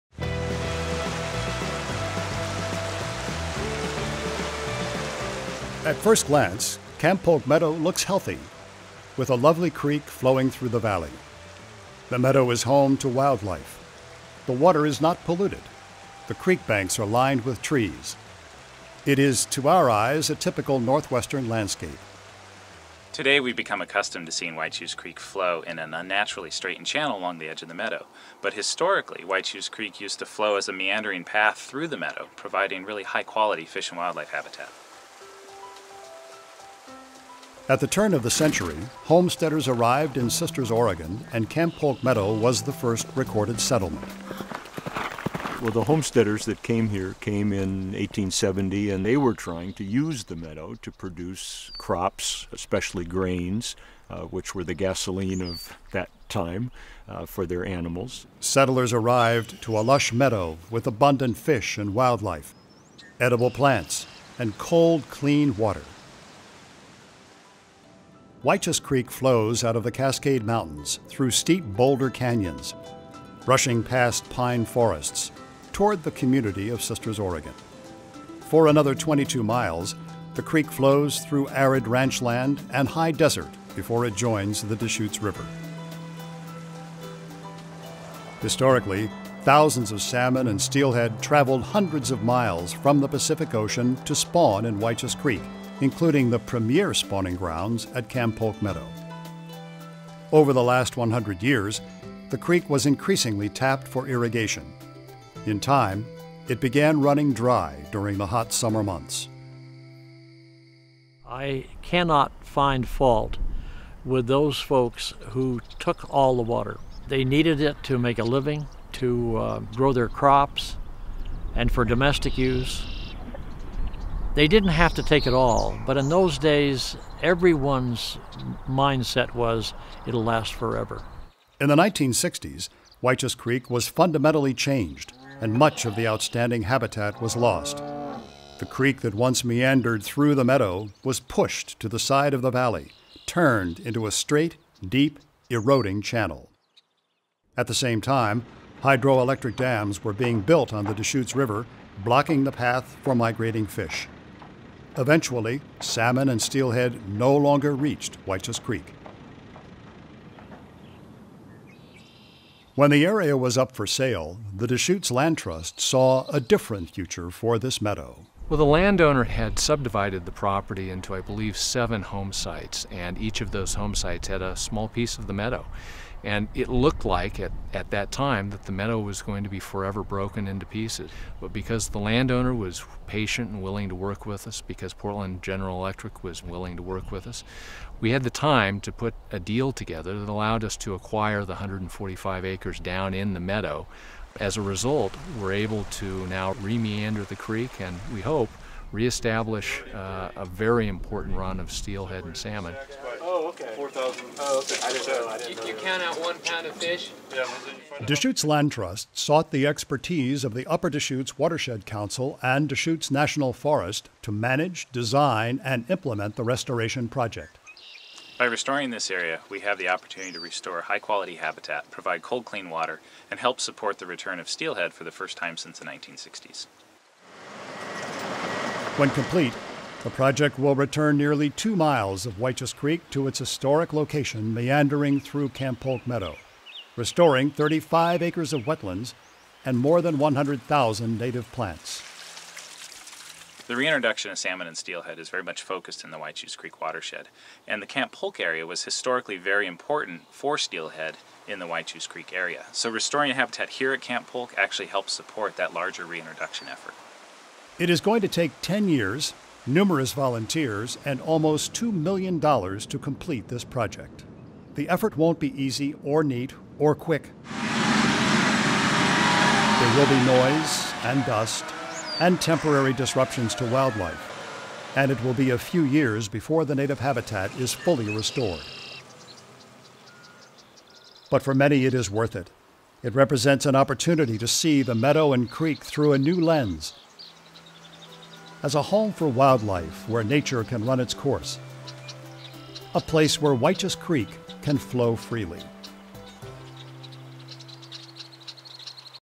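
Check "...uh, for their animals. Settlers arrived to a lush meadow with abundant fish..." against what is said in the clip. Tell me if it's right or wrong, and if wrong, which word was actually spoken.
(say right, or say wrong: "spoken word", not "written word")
right.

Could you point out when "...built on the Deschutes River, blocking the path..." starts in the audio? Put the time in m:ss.
2:30.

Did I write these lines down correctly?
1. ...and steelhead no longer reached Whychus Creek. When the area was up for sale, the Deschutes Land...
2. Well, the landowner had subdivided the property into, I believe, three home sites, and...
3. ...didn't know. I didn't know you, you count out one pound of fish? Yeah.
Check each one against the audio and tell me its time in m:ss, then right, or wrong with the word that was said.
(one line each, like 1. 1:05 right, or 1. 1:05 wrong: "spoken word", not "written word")
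1. 2:36 right
2. 2:48 wrong: "seven", not "three"
3. 3:24 right.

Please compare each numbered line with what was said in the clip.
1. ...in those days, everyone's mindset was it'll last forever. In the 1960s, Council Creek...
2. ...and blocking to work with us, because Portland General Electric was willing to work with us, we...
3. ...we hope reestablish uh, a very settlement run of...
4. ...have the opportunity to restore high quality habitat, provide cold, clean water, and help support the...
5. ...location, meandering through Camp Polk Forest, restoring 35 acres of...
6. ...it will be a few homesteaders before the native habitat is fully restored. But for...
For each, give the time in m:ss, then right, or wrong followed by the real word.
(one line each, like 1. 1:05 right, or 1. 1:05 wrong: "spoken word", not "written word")
1. 2:05 wrong: "Whychus", not "Council"
2. 3:03 wrong: "willing", not "blocking"
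3. 3:18 wrong: "important", not "settlement"
4. 3:39 right
5. 3:53 wrong: "Meadow", not "Forest"
6. 4:35 wrong: "years", not "homesteaders".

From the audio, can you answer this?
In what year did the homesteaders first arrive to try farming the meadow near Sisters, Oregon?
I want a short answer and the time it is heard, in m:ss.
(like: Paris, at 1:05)
1870, at 0:47.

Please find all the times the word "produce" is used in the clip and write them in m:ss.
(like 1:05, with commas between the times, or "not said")
0:50.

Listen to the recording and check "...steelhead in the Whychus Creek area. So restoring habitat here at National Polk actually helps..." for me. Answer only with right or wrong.
wrong.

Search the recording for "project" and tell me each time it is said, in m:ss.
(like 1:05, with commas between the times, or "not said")
3:37, 3:50, 4:23.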